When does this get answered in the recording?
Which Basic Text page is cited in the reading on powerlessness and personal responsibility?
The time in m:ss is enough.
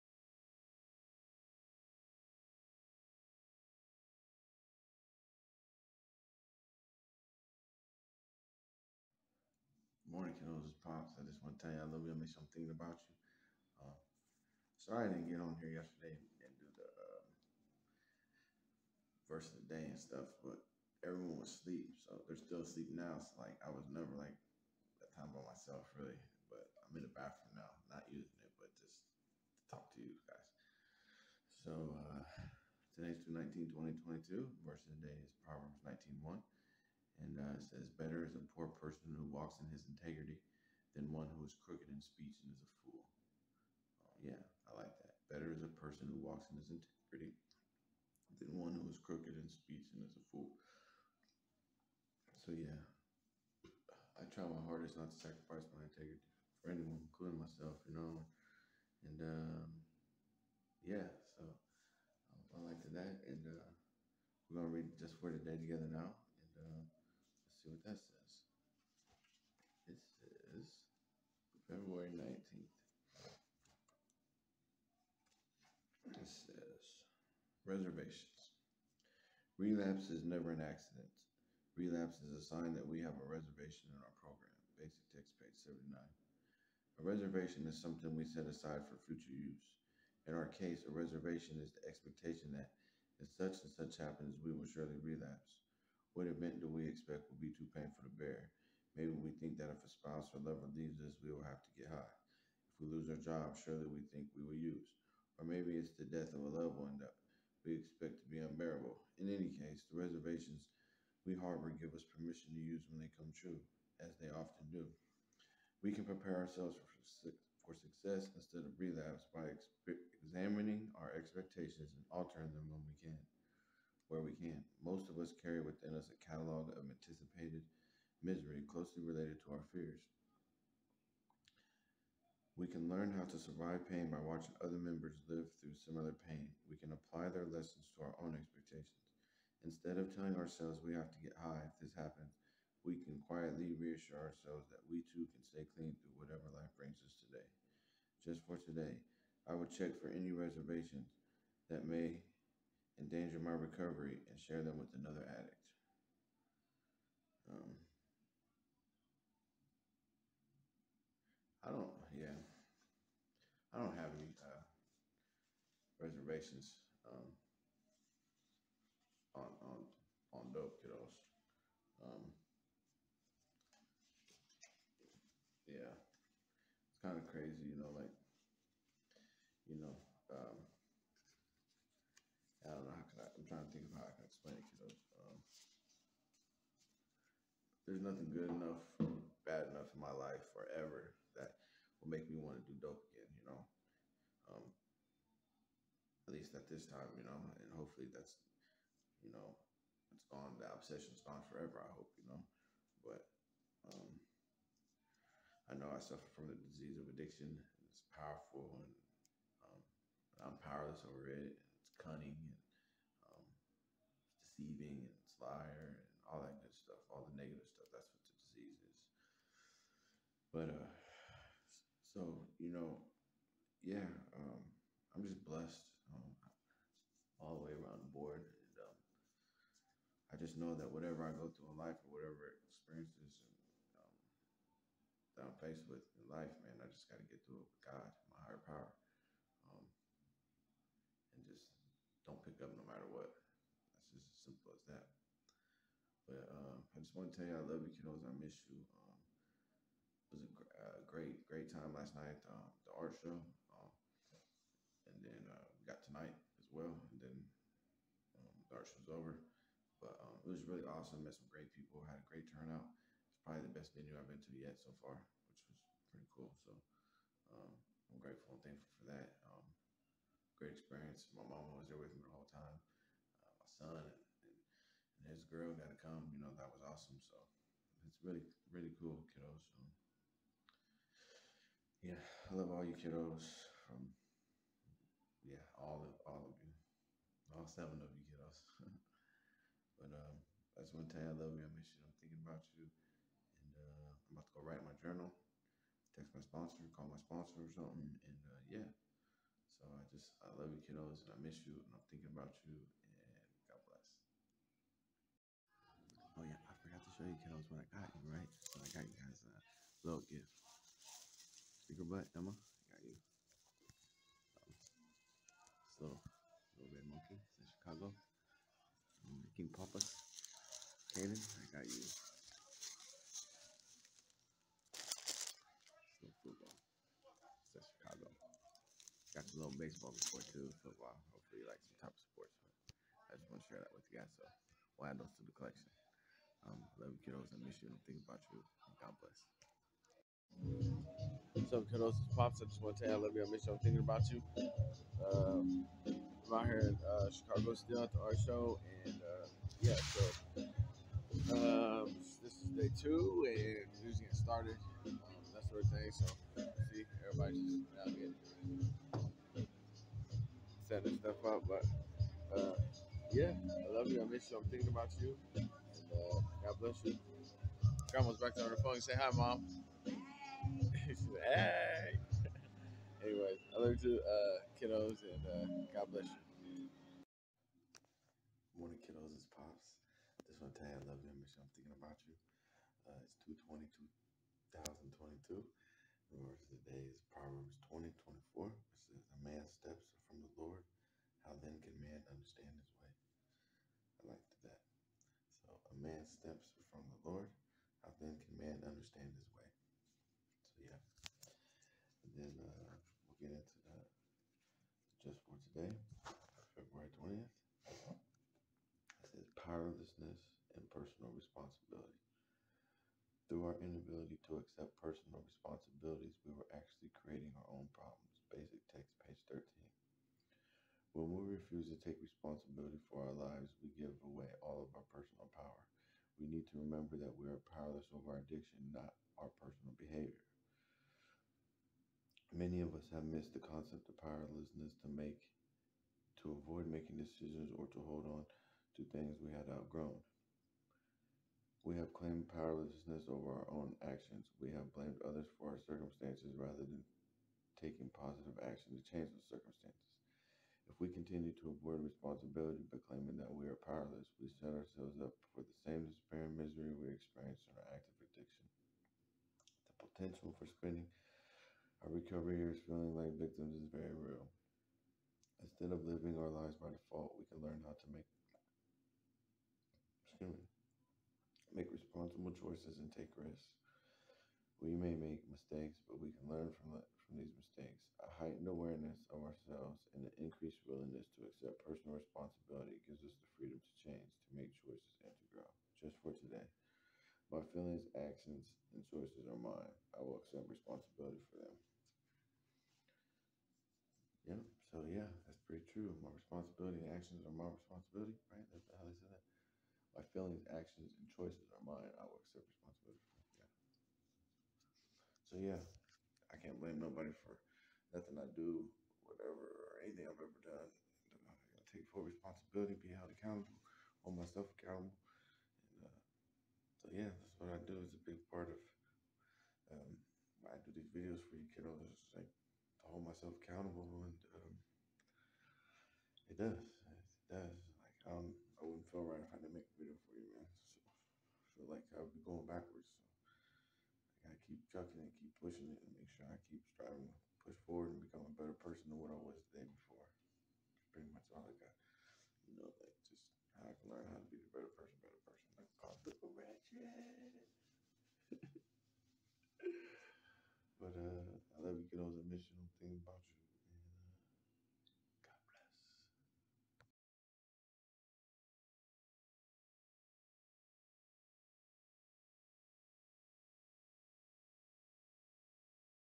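6:59.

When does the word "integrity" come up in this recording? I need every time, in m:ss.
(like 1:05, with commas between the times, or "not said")
0:39, 0:46, 0:55.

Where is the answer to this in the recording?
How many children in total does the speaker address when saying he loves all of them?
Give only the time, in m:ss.
4:47.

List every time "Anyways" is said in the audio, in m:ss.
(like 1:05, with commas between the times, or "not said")
6:13.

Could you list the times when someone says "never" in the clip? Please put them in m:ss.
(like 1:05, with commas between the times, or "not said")
0:23, 1:20.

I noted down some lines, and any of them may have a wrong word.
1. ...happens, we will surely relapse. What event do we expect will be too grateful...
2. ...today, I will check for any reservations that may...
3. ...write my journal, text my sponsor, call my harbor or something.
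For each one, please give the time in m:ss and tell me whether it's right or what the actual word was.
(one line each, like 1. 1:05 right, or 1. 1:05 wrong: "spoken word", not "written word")
1. 1:34 wrong: "painful", not "grateful"
2. 2:28 right
3. 4:54 wrong: "sponsor", not "harbor".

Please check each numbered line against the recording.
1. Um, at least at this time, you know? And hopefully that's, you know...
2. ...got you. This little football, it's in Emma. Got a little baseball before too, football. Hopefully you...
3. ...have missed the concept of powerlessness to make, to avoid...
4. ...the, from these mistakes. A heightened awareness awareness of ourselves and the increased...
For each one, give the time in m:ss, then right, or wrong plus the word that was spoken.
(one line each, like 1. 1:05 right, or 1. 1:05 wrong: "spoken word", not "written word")
1. 3:14 right
2. 5:21 wrong: "Chicago", not "Emma"
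3. 7:13 right
4. 7:56 right.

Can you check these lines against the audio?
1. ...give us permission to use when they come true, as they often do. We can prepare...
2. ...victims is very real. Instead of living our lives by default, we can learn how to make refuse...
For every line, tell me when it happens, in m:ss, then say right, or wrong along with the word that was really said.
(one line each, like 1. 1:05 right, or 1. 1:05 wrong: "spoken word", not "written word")
1. 1:51 right
2. 7:43 wrong: "excuse", not "refuse".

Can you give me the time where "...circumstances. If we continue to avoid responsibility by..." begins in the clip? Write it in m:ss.
7:29.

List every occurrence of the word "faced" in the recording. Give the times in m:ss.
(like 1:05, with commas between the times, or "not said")
3:55.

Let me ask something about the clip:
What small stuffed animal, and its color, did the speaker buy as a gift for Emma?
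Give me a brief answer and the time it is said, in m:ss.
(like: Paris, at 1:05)
Red monkey, at 5:16.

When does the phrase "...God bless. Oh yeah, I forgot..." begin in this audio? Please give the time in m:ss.
5:03.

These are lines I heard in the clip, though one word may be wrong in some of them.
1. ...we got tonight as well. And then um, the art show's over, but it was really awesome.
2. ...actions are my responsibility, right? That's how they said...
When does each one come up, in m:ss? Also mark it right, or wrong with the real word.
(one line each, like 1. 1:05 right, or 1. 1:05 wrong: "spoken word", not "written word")
1. 4:15 right
2. 8:17 right.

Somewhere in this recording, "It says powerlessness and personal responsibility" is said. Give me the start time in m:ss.
6:47.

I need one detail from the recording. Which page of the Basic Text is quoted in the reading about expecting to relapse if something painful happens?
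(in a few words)
79.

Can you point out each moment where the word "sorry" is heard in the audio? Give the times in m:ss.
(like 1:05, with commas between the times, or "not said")
0:14.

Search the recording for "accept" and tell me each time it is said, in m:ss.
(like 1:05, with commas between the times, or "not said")
6:54, 8:01, 8:10, 8:22.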